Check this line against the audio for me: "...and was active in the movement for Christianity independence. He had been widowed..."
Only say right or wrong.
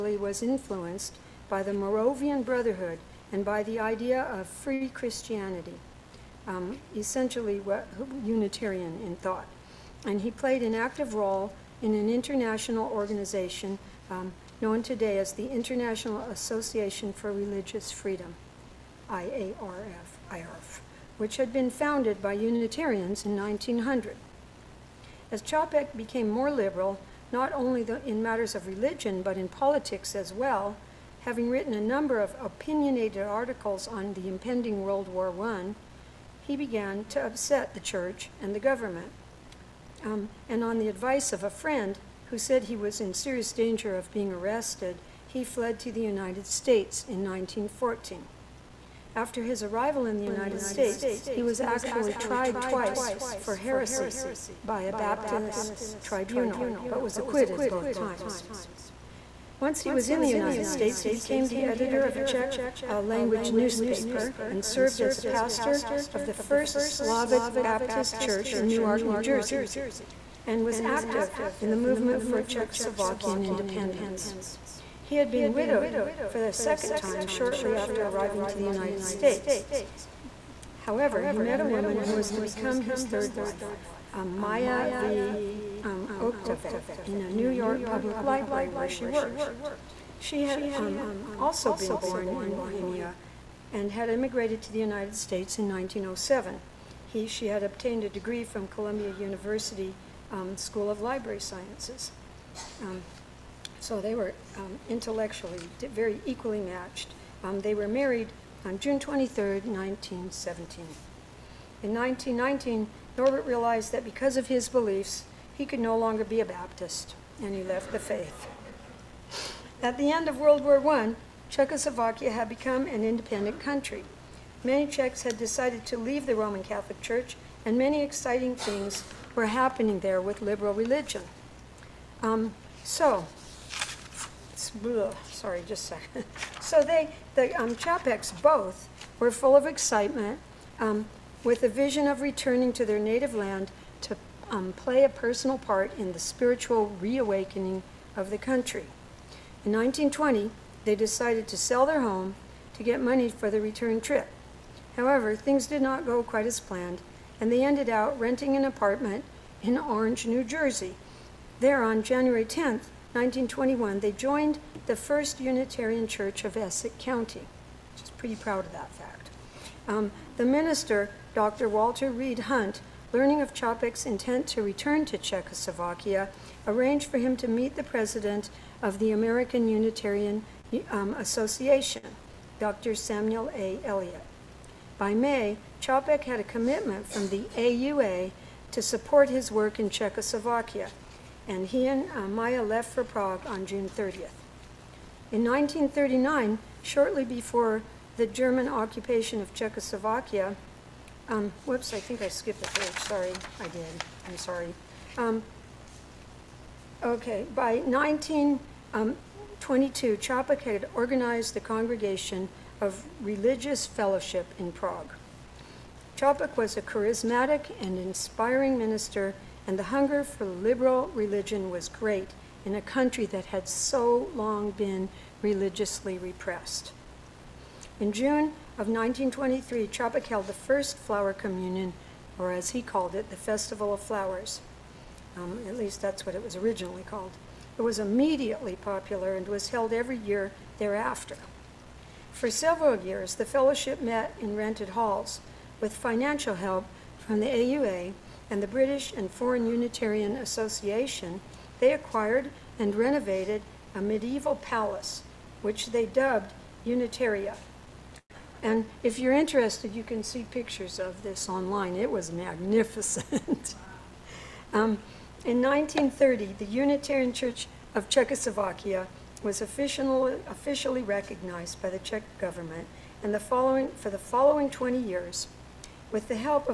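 wrong.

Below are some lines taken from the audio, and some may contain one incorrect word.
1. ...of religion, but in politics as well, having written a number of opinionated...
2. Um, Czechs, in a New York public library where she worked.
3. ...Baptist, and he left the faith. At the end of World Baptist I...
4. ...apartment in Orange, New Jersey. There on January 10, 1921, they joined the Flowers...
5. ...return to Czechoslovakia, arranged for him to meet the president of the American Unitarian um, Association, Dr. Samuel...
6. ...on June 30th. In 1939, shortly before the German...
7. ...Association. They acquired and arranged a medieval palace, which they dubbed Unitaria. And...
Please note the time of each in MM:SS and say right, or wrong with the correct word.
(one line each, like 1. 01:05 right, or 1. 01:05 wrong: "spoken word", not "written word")
1. 00:28 right
2. 01:25 wrong: "Oktavec", not "Czechs"
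3. 01:56 wrong: "War", not "Baptist"
4. 02:38 wrong: "First", not "Flowers"
5. 02:54 right
6. 03:13 right
7. 04:10 wrong: "renovated", not "arranged".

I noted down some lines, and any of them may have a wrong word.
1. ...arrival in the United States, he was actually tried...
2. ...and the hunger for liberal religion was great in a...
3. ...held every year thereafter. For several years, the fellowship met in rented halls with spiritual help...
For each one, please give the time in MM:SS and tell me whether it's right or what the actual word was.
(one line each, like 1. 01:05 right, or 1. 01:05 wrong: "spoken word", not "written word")
1. 00:49 right
2. 03:39 right
3. 03:59 wrong: "financial", not "spiritual".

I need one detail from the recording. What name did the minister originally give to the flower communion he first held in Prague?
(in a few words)
Festival of Flowers.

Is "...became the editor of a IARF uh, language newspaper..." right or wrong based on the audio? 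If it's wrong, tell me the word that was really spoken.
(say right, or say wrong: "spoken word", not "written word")
wrong: "Czech", not "IARF".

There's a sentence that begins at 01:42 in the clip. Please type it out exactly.
Um, so they were um, intellectually very equally matched.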